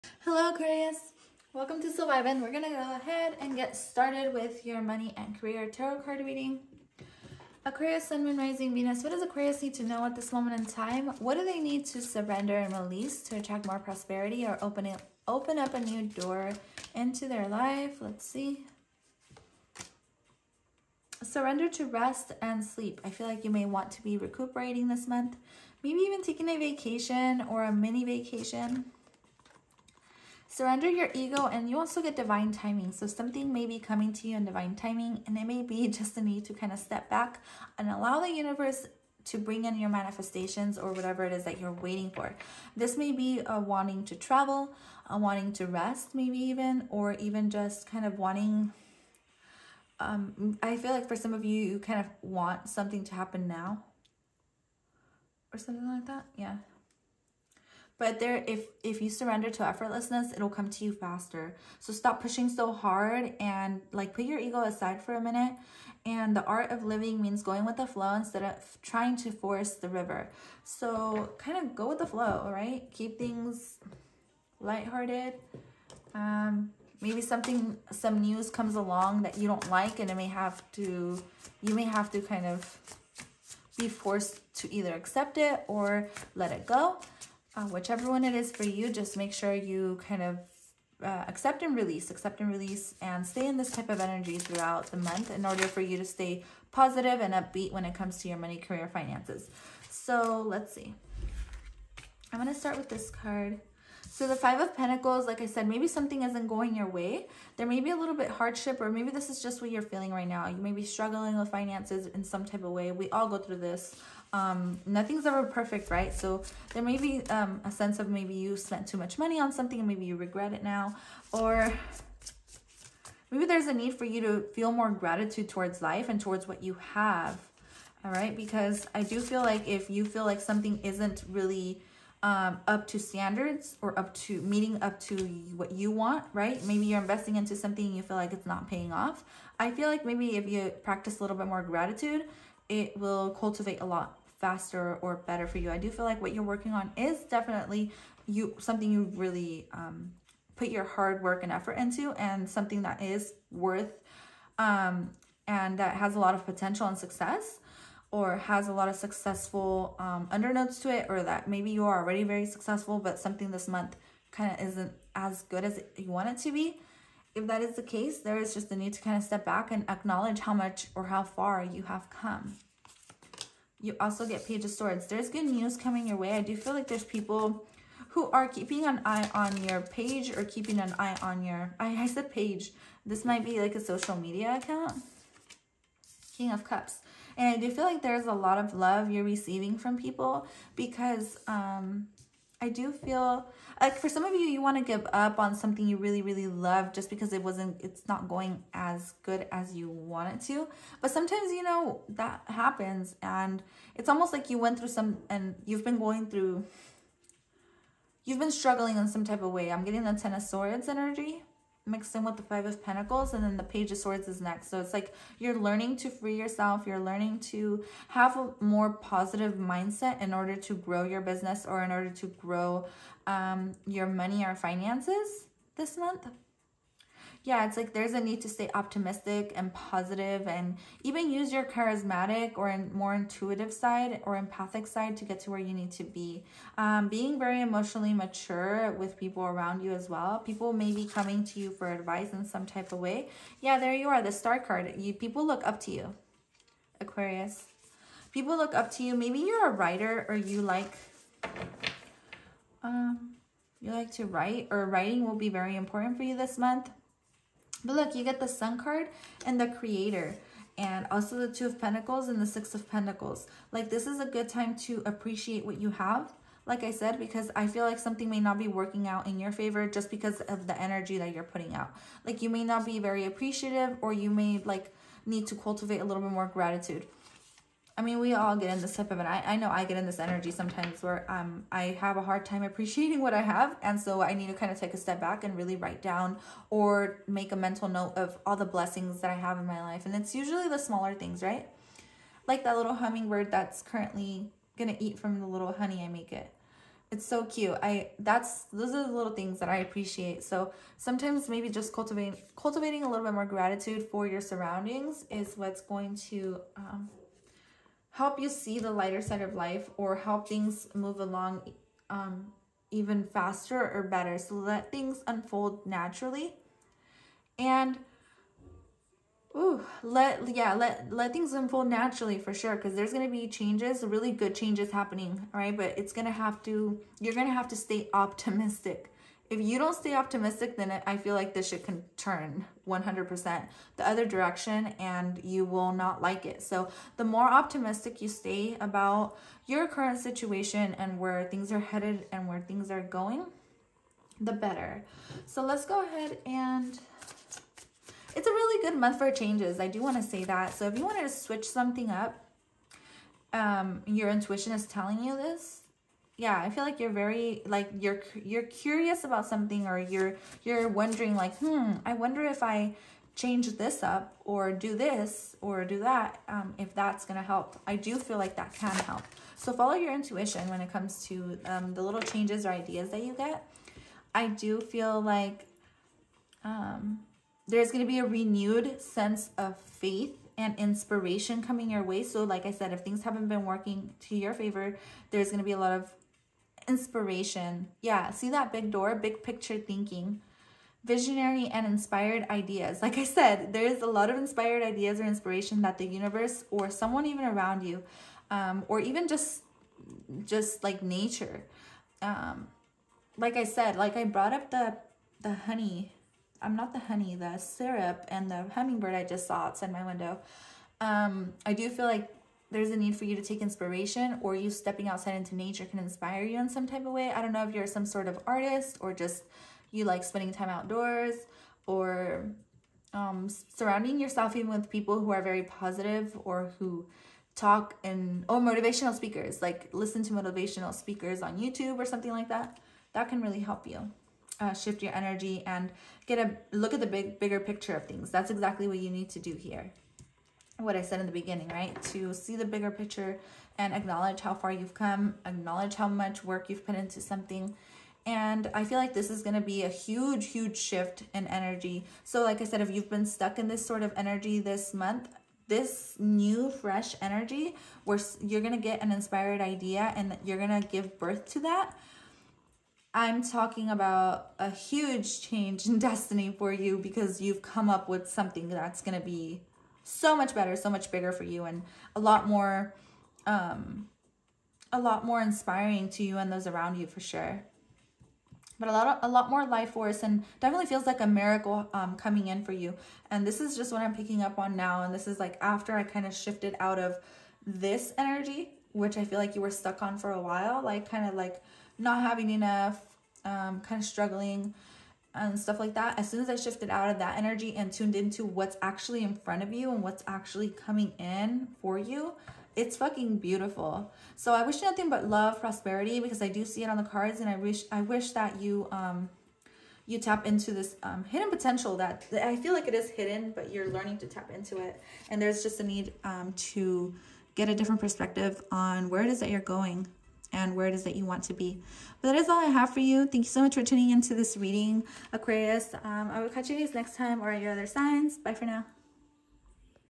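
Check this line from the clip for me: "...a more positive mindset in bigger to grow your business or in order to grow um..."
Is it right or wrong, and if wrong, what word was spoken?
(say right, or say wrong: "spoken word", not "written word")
wrong: "order", not "bigger".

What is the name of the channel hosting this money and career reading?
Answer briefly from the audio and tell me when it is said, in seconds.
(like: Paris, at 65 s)
Soul Vibin, at 1 s.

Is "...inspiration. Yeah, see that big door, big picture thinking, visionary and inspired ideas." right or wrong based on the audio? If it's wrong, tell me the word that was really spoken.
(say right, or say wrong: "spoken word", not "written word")
right.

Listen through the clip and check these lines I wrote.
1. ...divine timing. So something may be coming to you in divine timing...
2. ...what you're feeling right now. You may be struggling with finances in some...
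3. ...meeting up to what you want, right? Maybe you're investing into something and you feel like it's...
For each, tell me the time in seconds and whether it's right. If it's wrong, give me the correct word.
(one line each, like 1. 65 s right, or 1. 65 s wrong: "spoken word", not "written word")
1. 32 s right
2. 109 s right
3. 134 s right.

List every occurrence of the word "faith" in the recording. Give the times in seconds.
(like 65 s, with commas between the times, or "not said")
379 s.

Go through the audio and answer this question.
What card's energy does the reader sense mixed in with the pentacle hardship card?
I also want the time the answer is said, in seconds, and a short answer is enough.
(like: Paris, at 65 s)
Ten of Swords, at 210 s.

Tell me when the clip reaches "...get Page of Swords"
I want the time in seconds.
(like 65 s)
174 s.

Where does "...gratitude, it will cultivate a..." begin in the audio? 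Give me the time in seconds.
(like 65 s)
141 s.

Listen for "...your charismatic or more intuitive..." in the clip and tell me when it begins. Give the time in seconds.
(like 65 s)
231 s.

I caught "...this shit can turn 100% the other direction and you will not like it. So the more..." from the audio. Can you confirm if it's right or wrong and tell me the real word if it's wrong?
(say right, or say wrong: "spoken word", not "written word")
right.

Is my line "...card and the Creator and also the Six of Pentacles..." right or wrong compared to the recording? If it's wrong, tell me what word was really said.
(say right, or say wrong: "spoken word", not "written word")
wrong: "Two", not "Six".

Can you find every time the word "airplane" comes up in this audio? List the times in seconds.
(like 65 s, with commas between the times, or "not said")
not said.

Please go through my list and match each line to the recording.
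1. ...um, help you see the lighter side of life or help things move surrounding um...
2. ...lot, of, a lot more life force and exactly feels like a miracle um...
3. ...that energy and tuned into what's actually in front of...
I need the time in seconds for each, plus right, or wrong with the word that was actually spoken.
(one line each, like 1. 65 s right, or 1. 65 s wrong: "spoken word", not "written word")
1. 306 s wrong: "along", not "surrounding"
2. 478 s wrong: "definitely", not "exactly"
3. 497 s right.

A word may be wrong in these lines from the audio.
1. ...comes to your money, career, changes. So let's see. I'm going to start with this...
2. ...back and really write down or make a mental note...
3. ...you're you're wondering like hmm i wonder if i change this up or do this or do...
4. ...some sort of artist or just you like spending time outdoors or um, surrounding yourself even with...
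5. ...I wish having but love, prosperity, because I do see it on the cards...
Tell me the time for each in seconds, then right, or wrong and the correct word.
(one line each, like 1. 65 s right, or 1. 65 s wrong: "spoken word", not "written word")
1. 97 s wrong: "finances", not "changes"
2. 285 s right
3. 359 s right
4. 417 s right
5. 504 s wrong: "nothing", not "having".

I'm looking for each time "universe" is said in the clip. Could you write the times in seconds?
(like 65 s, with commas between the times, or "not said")
38 s, 396 s.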